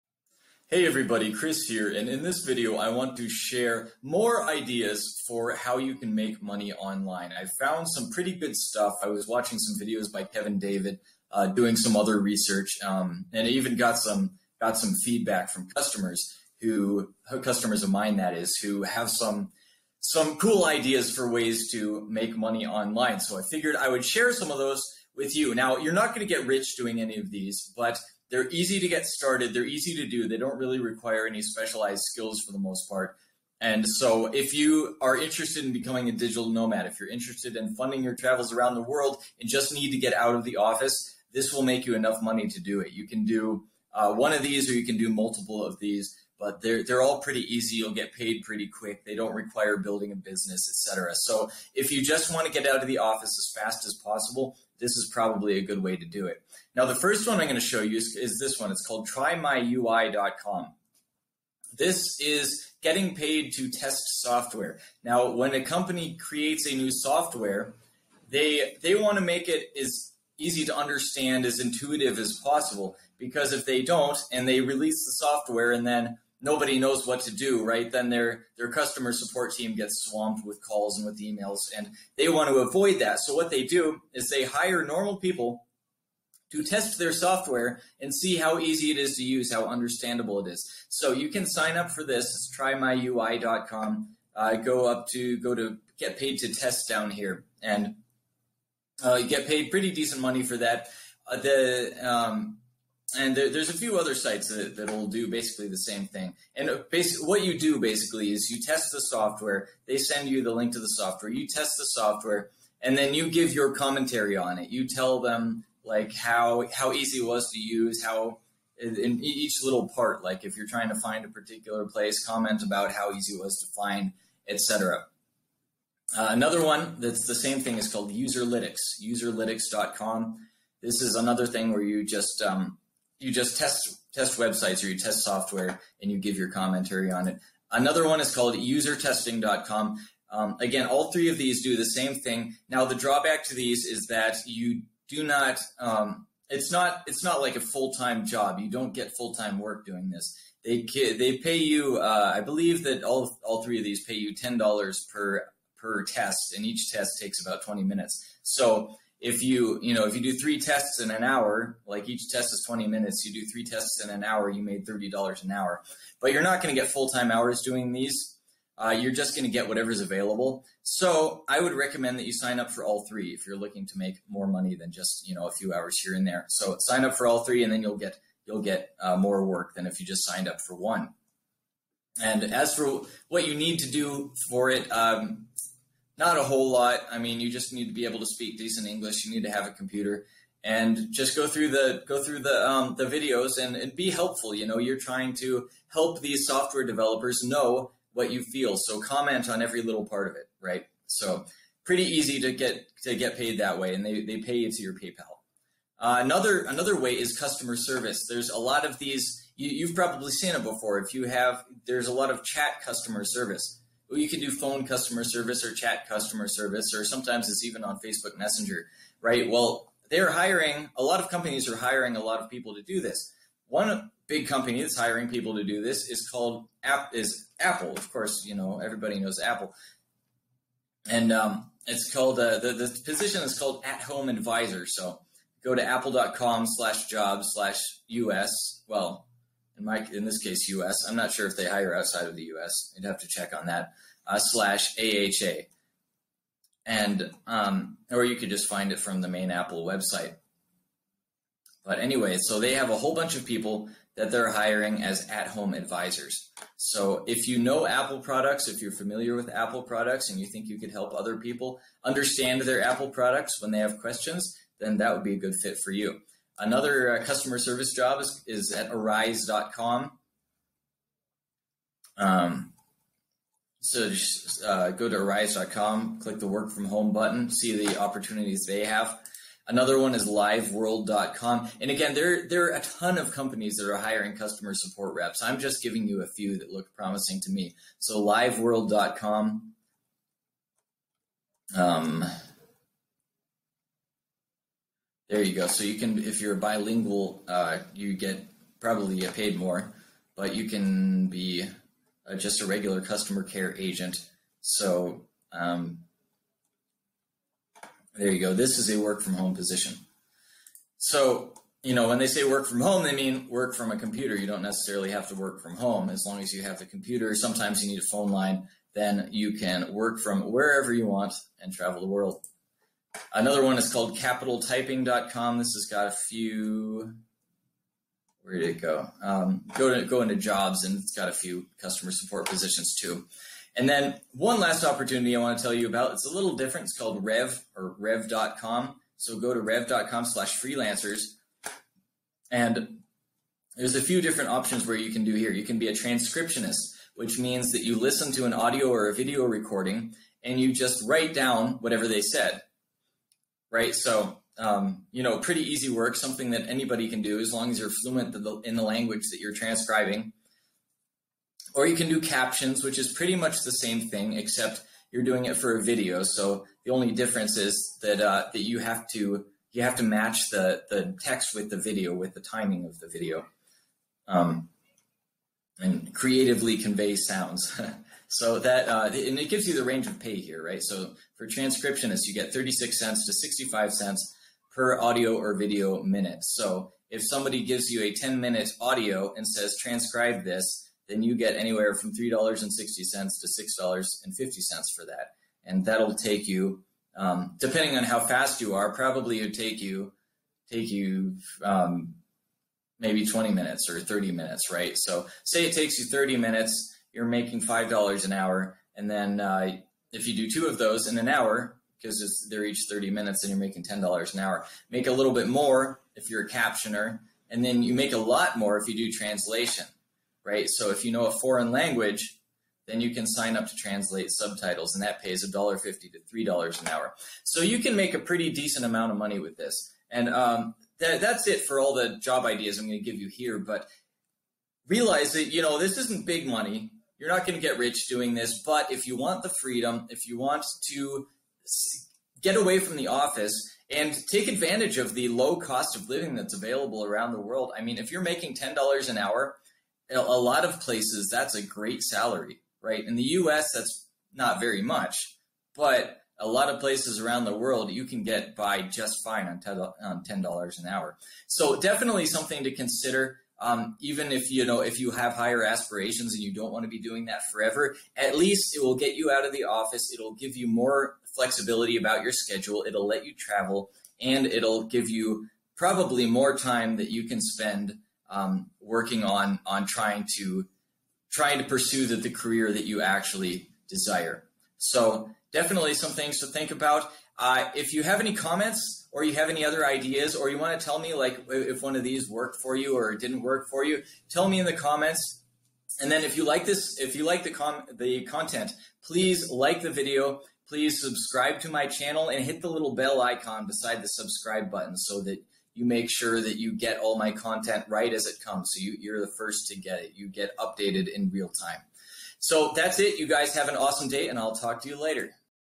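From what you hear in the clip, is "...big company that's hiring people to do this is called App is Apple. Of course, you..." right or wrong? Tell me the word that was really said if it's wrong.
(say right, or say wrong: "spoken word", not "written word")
right.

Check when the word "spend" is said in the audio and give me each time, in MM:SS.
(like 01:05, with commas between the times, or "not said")
07:57.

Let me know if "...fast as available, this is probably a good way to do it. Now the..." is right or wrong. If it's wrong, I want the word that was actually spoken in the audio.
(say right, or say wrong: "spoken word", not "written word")
wrong: "possible", not "available".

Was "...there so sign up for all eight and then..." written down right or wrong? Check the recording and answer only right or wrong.
wrong.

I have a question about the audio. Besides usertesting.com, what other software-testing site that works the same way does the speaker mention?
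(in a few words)
Userlytics.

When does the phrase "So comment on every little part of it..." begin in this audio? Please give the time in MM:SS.
03:18.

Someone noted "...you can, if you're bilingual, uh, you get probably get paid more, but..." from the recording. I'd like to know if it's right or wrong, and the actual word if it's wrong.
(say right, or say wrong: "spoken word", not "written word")
right.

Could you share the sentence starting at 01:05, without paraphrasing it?
Now, when a company creates a new software, they they want to make it as easy to understand, as intuitive as possible.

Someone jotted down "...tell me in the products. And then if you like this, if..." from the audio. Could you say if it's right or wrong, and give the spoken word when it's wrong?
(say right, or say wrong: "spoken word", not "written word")
wrong: "comments", not "products".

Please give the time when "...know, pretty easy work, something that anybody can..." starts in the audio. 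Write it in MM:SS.
05:55.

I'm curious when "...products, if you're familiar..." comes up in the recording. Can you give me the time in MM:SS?
04:18.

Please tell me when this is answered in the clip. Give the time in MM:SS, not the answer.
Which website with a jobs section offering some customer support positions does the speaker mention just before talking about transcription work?
05:24.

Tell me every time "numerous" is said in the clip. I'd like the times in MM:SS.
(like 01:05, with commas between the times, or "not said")
not said.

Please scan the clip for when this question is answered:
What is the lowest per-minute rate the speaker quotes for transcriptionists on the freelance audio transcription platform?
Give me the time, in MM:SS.
06:22.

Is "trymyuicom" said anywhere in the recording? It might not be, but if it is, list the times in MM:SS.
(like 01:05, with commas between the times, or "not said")
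00:59, 01:32.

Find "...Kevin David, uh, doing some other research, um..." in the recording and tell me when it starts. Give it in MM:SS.
00:10.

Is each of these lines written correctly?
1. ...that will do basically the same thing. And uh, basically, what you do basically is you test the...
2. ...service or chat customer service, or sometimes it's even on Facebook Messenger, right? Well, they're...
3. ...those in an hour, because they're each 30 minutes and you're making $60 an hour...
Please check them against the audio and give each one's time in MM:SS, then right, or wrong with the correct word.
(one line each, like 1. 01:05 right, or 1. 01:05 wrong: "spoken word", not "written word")
1. 01:44 right
2. 03:35 right
3. 06:50 wrong: "10", not "60".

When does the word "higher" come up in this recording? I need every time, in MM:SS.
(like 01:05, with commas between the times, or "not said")
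07:45.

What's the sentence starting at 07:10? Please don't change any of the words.
And um, that's it for all the job ideas I'm going to give you here.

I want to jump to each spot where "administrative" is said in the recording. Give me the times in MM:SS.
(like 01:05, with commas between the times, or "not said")
not said.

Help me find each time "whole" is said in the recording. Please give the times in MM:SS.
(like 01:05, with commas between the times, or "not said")
03:06, 04:12.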